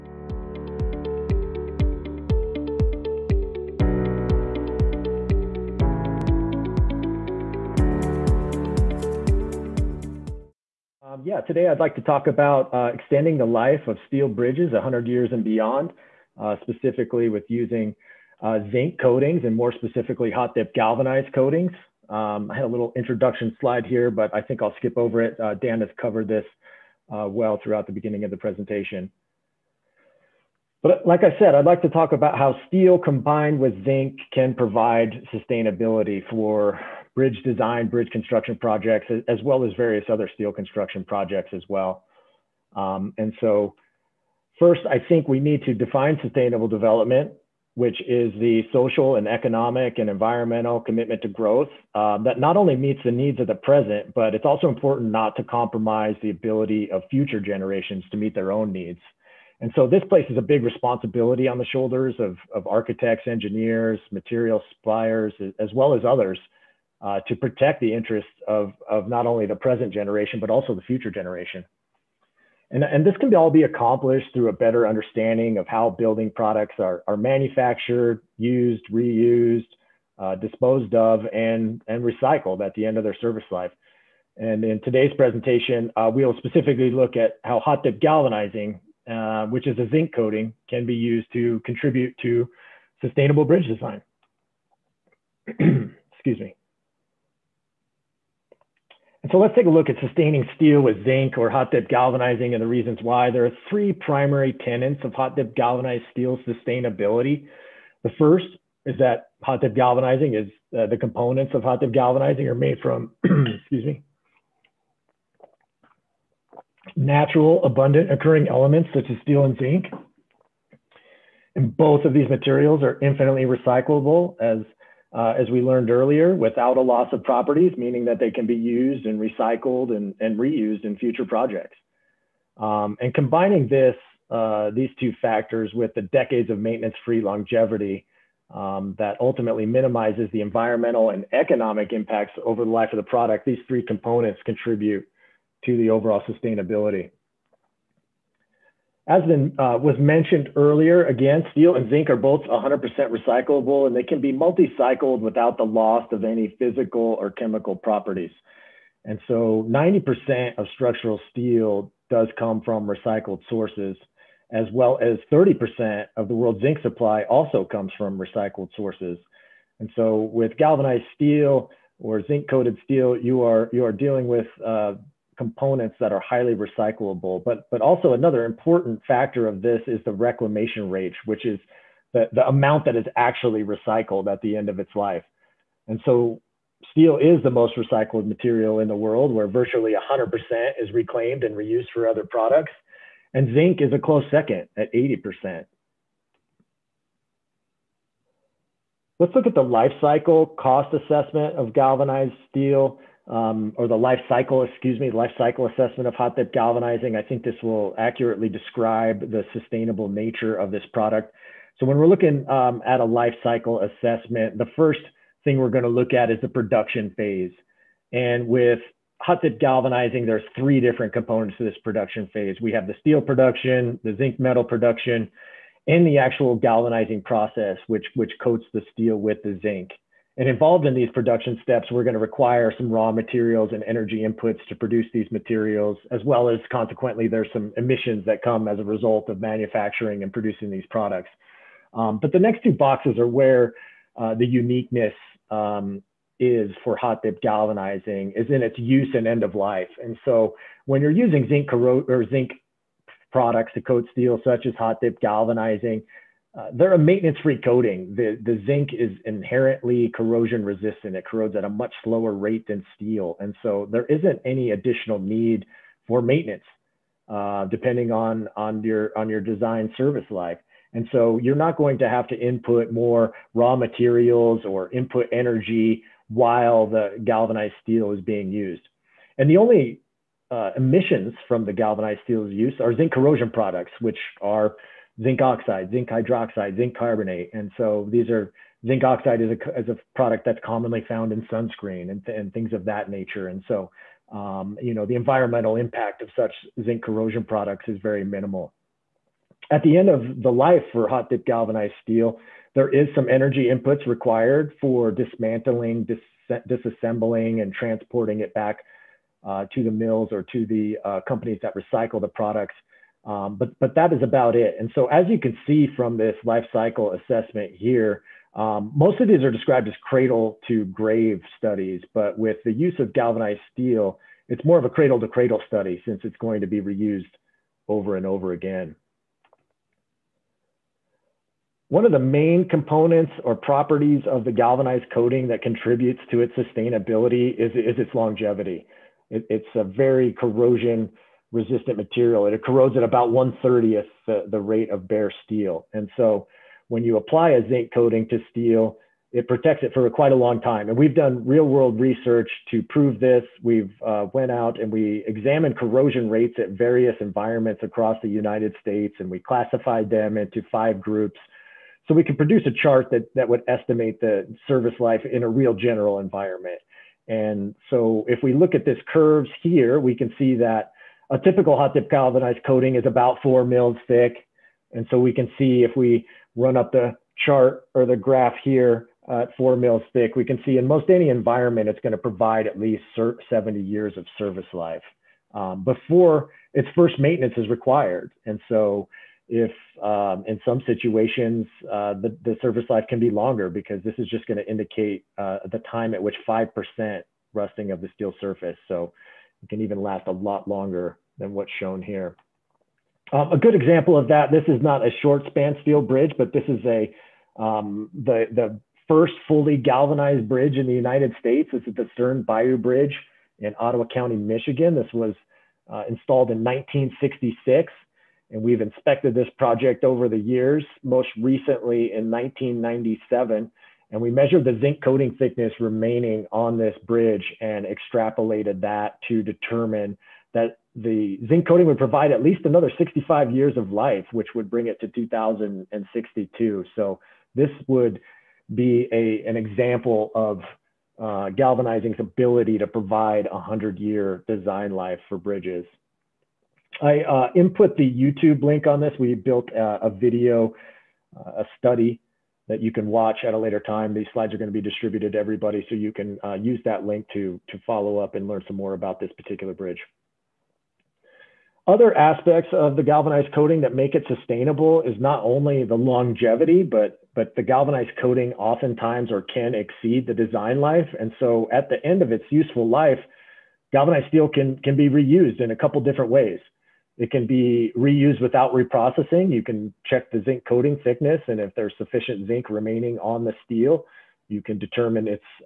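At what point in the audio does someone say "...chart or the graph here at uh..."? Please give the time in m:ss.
6:17.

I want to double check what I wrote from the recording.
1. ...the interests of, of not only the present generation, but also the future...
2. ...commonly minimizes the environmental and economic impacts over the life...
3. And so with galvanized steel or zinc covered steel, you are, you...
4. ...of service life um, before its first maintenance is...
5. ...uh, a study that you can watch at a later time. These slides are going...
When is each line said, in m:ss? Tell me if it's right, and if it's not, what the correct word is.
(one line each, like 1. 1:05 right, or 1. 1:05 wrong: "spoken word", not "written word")
1. 1:07 right
2. 2:19 wrong: "ultimately", not "commonly"
3. 2:49 wrong: "coated", not "covered"
4. 6:24 right
5. 7:31 right.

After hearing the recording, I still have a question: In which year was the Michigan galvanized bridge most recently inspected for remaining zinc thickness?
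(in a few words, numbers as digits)
1997.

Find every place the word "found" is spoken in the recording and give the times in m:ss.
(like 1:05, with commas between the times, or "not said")
4:51.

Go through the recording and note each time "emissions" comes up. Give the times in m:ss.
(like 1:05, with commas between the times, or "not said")
3:57, 4:40.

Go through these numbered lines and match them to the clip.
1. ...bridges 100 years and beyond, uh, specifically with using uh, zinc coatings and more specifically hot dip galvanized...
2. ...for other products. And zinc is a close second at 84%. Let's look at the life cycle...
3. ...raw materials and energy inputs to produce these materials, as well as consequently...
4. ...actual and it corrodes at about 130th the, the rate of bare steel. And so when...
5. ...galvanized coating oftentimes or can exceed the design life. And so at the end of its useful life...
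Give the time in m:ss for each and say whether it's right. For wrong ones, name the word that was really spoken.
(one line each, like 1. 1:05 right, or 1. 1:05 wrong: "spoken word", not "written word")
1. 0:14 right
2. 3:11 wrong: "80", not "84"
3. 3:52 right
4. 5:41 wrong: "material", not "actual"
5. 7:47 right.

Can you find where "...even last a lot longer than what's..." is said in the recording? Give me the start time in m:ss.
6:39.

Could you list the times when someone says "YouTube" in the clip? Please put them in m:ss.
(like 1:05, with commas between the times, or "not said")
7:28.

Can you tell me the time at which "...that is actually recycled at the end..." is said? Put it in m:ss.
3:02.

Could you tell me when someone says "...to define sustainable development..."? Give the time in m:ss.
0:45.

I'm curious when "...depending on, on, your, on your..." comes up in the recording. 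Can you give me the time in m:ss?
4:27.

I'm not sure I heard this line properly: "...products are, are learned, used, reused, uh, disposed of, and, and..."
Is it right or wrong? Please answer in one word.
wrong.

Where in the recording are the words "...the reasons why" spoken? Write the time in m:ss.
1:42.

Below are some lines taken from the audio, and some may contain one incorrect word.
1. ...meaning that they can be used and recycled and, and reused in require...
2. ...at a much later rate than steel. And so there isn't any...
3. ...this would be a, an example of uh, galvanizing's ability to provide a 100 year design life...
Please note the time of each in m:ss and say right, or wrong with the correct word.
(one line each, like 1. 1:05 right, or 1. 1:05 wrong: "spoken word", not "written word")
1. 2:07 wrong: "future", not "require"
2. 4:21 wrong: "slower", not "later"
3. 7:17 right.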